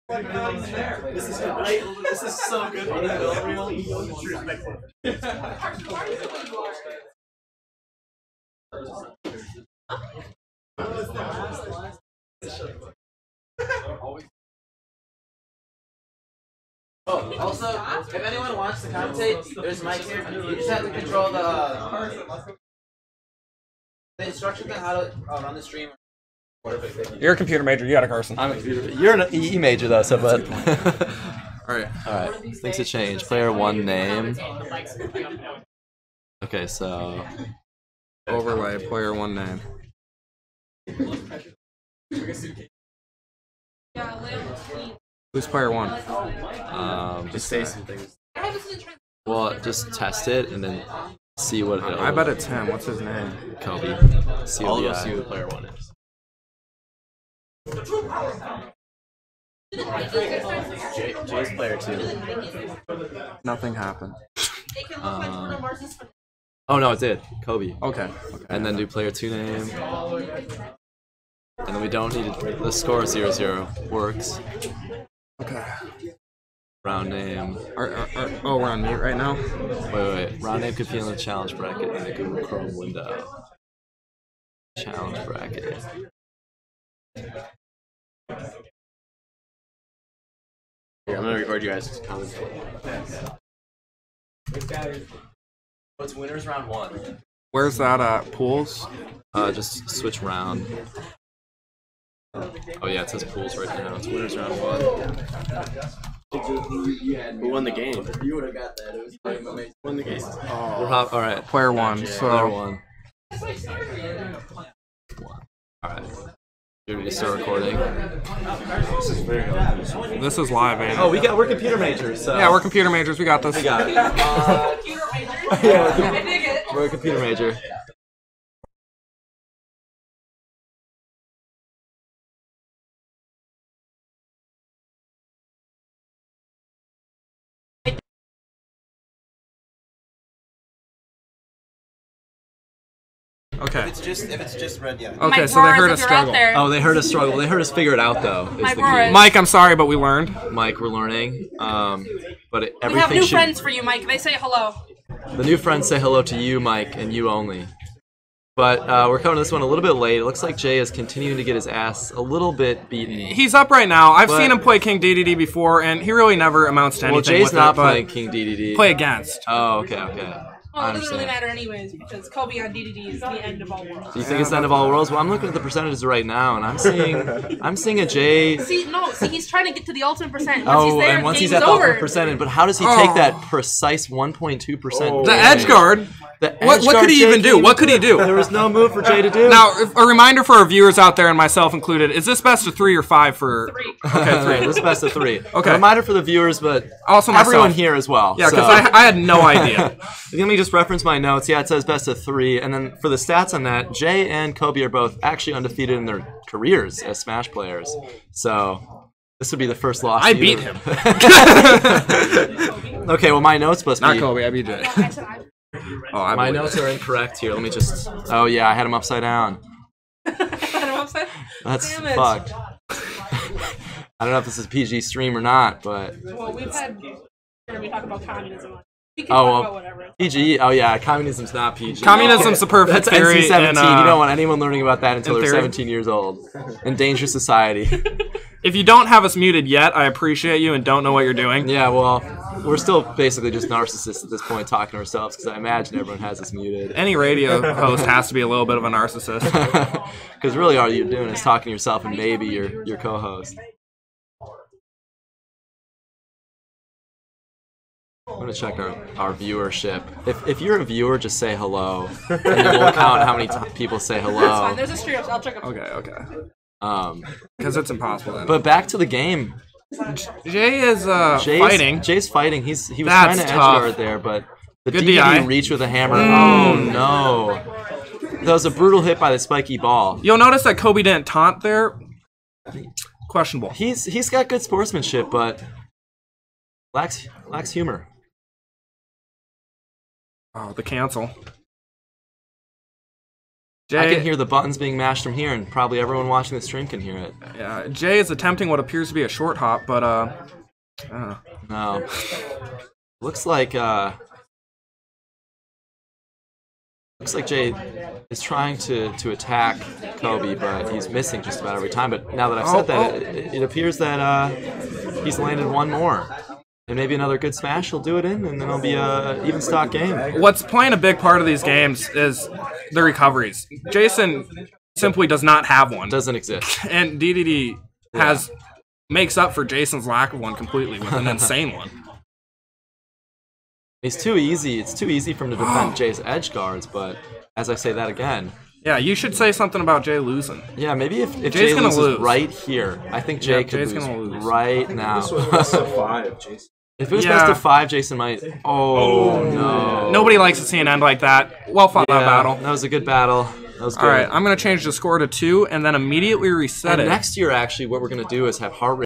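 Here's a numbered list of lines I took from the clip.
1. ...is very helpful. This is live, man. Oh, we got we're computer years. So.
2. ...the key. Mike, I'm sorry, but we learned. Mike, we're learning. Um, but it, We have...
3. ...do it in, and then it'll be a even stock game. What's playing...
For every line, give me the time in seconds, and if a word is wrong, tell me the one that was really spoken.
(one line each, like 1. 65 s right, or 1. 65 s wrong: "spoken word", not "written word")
1. 119 s wrong: "majors", not "years"
2. 148 s right
3. 318 s right.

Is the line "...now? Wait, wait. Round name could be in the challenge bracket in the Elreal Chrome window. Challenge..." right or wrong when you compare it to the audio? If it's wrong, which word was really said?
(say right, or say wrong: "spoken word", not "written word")
wrong: "Google", not "Elreal".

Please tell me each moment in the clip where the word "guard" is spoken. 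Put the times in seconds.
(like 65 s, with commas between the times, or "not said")
185 s, 273 s, 336 s.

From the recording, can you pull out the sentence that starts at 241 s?
Yeah, well, we're still basically just narcissists at this point talking to ourselves because I imagine everyone has us muted.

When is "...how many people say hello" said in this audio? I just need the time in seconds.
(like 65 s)
263 s.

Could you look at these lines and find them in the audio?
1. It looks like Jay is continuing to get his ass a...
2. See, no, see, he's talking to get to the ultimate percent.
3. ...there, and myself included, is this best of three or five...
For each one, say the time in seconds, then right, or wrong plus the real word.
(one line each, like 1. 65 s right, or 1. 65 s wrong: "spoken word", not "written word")
1. 160 s right
2. 178 s wrong: "trying", not "talking"
3. 191 s right.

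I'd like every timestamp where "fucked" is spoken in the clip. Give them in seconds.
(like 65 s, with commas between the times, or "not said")
222 s.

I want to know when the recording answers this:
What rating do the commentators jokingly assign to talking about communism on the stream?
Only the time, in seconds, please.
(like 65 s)
233 s.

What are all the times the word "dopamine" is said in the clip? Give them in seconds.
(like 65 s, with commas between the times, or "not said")
not said.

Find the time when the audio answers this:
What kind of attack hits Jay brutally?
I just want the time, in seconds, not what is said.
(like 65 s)
279 s.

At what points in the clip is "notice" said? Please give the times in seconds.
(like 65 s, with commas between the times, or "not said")
280 s.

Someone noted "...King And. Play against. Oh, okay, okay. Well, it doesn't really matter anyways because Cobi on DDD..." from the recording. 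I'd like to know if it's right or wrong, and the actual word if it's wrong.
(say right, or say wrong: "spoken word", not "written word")
wrong: "DDD", not "And".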